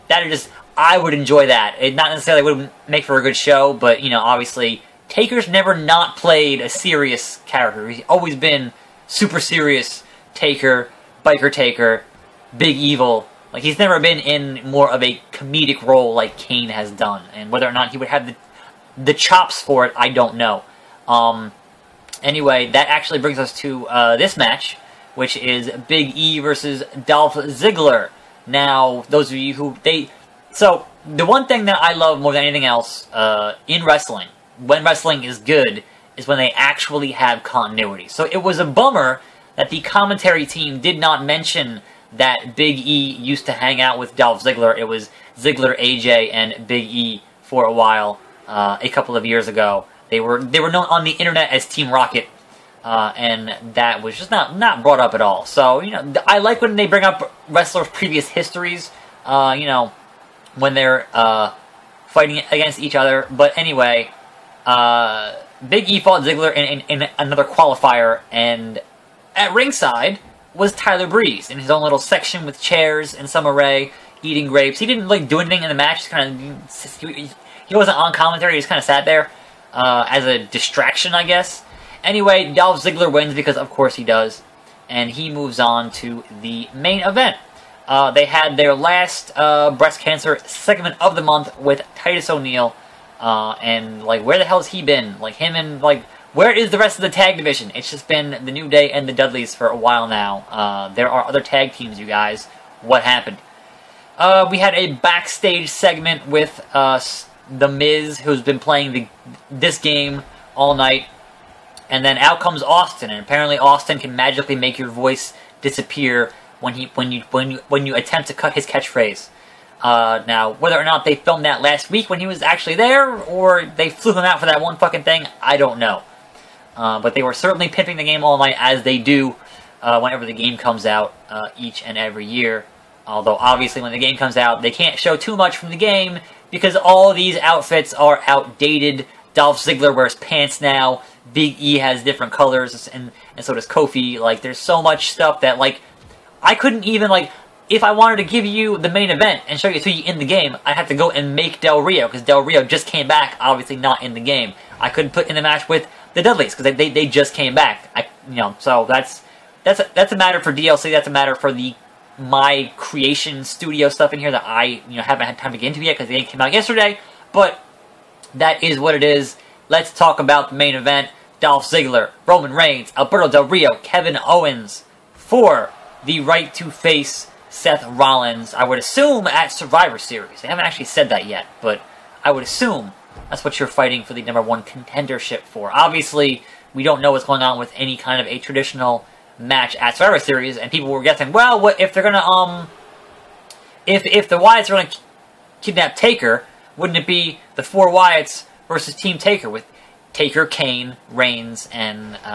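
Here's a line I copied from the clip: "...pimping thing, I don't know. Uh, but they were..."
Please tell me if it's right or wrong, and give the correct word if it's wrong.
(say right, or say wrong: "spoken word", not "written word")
wrong: "fucking", not "pimping".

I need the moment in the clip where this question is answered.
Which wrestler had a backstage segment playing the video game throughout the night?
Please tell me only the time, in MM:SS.
01:47.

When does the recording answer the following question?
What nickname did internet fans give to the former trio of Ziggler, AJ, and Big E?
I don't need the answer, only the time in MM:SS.
00:51.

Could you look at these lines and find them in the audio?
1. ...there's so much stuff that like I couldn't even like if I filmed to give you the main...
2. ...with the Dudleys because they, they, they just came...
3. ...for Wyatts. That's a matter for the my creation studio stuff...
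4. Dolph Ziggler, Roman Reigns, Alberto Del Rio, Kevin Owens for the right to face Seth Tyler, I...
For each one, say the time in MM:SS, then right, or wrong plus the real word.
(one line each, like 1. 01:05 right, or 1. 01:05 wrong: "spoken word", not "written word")
1. 02:24 wrong: "wanted", not "filmed"
2. 02:35 right
3. 02:40 wrong: "DLC", not "Wyatts"
4. 02:51 wrong: "Rollins", not "Tyler".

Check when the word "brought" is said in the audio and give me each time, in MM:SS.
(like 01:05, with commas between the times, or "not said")
00:54.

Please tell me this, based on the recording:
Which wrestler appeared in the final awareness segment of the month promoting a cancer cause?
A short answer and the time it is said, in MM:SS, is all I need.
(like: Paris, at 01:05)
Titus O'Neil, at 01:31.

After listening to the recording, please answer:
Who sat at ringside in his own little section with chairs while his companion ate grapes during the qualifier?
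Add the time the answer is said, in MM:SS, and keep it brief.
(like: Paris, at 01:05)
Tyler Breeze, at 01:10.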